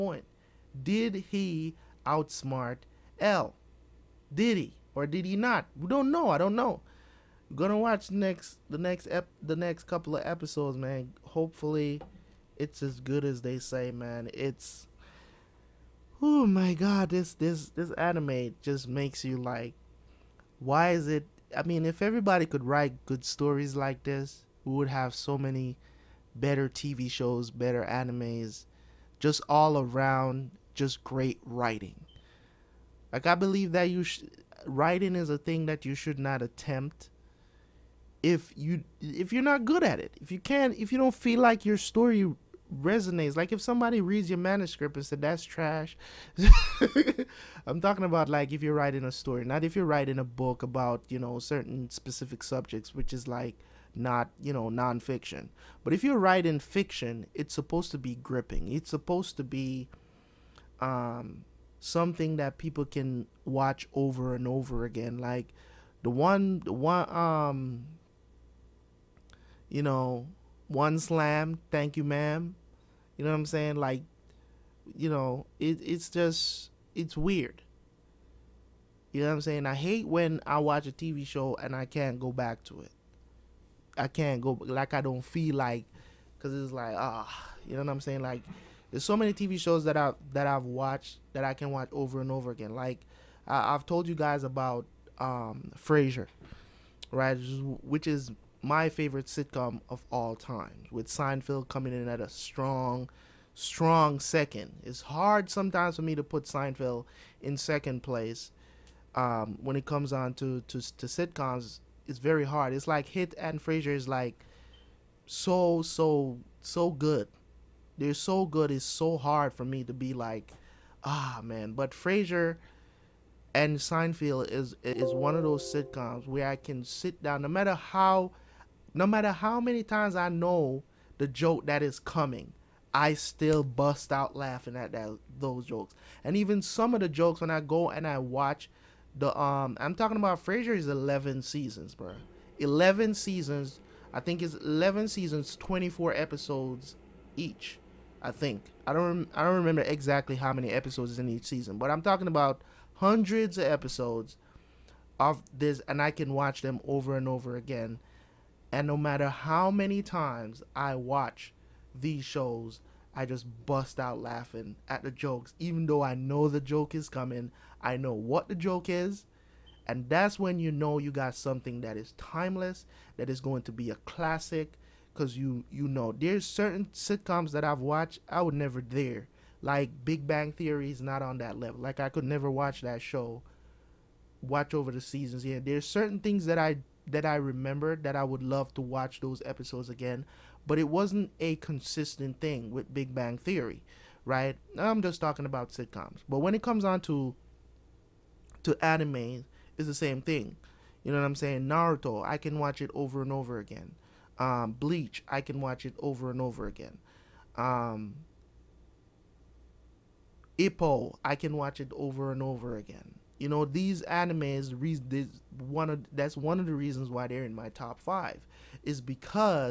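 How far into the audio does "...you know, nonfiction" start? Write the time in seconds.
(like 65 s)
54 s.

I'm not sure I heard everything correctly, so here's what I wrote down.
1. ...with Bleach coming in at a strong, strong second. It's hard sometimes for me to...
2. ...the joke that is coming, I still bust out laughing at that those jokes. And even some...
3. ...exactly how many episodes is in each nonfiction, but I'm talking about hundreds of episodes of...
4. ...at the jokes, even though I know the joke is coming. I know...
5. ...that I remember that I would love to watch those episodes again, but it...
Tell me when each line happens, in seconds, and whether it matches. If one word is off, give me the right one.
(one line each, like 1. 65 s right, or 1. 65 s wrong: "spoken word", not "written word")
1. 100 s wrong: "Seinfeld", not "Bleach"
2. 131 s right
3. 149 s wrong: "season", not "nonfiction"
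4. 164 s right
5. 187 s right.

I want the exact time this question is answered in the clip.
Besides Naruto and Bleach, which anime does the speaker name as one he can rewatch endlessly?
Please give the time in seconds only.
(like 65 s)
210 s.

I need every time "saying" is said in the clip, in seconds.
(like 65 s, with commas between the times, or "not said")
73 s, 79 s, 87 s, 201 s.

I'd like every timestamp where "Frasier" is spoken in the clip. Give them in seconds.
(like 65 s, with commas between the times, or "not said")
95 s, 113 s, 121 s, 140 s.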